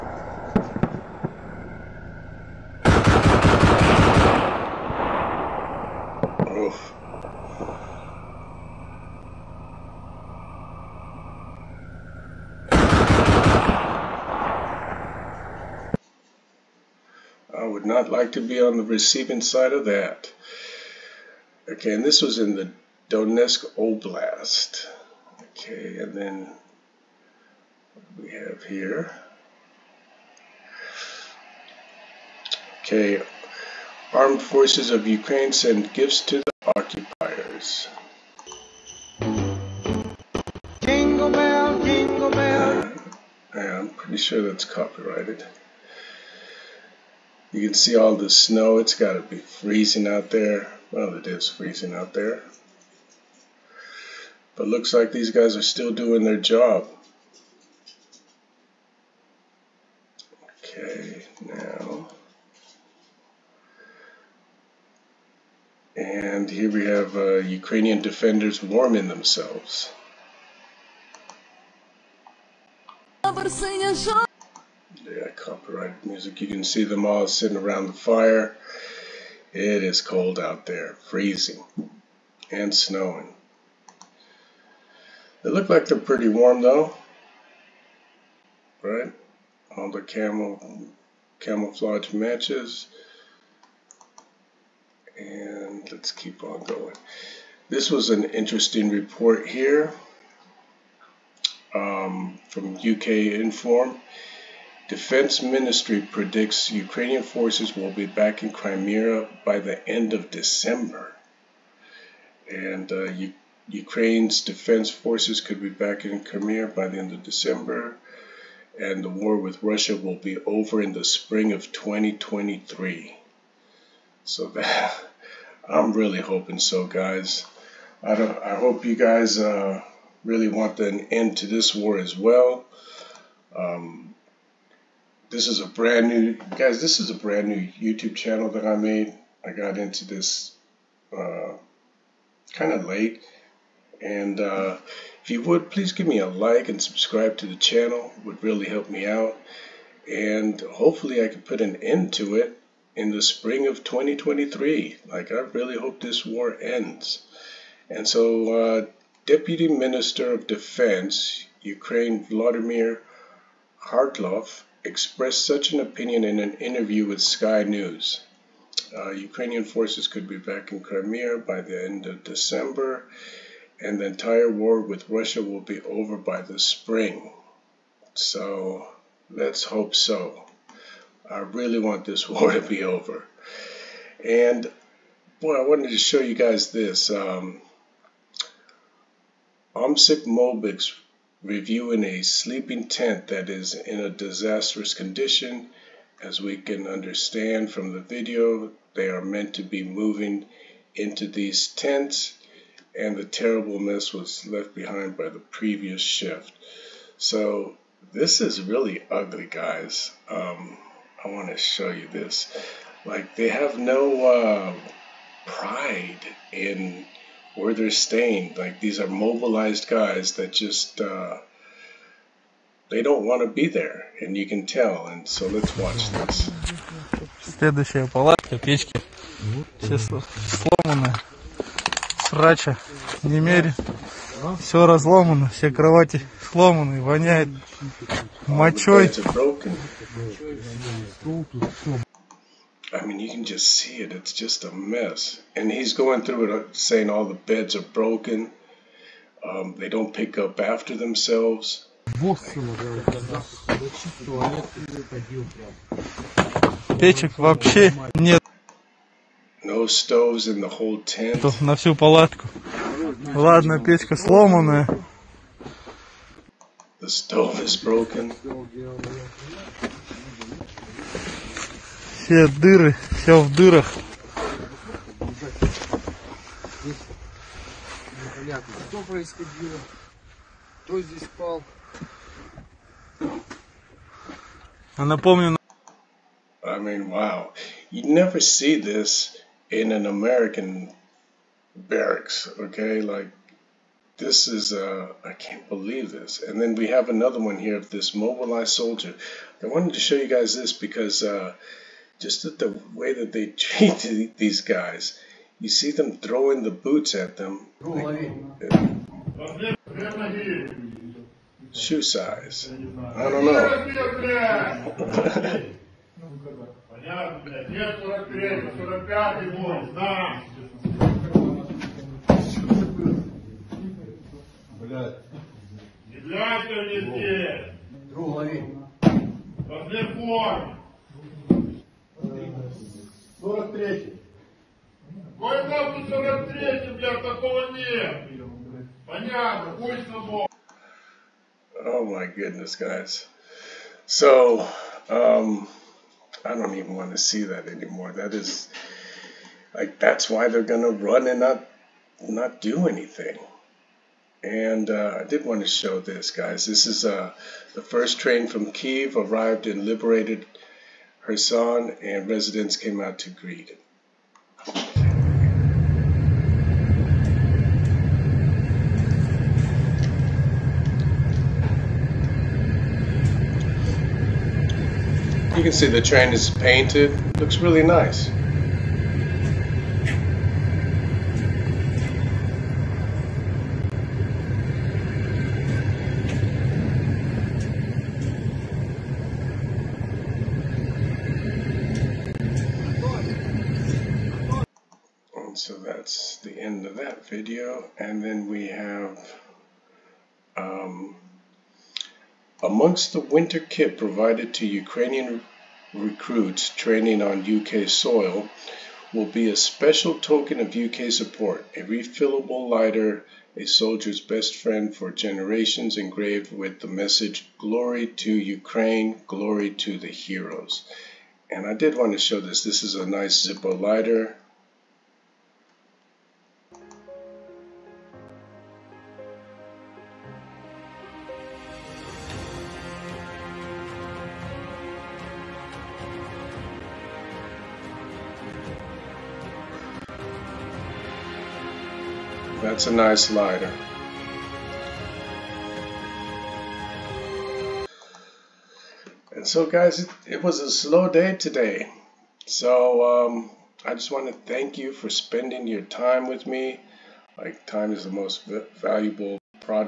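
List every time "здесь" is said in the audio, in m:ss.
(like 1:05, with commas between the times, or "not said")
4:40, 5:26.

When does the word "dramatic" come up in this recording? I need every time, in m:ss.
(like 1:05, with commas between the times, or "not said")
not said.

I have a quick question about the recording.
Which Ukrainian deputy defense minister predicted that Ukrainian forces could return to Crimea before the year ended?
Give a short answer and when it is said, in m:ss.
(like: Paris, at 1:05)
Vladimir Havrylov, at 2:42.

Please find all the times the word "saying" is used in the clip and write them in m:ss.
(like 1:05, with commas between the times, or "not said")
4:06.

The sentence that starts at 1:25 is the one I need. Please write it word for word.
They look like they're pretty warm though, right?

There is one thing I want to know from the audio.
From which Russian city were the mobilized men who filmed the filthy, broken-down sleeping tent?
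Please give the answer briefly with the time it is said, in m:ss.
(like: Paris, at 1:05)
Omsk, at 3:09.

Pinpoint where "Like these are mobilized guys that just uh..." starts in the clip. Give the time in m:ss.
3:38.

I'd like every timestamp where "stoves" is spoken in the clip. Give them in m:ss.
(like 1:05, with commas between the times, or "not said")
4:19, 4:27.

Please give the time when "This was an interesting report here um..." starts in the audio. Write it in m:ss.
1:37.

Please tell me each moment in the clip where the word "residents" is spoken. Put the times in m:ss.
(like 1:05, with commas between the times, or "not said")
6:02.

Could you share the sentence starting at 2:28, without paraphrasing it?
It would really help me out.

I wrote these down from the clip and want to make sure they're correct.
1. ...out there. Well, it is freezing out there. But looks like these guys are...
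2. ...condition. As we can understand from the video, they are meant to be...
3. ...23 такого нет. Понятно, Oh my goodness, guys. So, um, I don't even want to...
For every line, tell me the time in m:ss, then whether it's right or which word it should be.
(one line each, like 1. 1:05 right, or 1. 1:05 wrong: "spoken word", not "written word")
1. 0:50 right
2. 3:14 right
3. 5:35 wrong: "43", not "23".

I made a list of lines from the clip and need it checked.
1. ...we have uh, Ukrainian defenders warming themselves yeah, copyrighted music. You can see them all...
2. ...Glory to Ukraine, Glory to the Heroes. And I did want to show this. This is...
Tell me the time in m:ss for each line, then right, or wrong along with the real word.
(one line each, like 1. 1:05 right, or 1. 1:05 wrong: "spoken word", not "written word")
1. 1:06 right
2. 6:57 right.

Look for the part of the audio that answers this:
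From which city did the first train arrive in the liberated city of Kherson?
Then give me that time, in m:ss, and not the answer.
5:58.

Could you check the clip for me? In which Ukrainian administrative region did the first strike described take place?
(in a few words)
Donetsk Oblast.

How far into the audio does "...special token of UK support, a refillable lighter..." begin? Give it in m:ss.
6:49.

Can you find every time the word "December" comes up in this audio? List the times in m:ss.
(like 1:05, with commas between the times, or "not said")
1:50, 1:57, 2:52.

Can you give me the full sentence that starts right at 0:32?
Okay, armed forces of Ukraine send gifts to the occupiers.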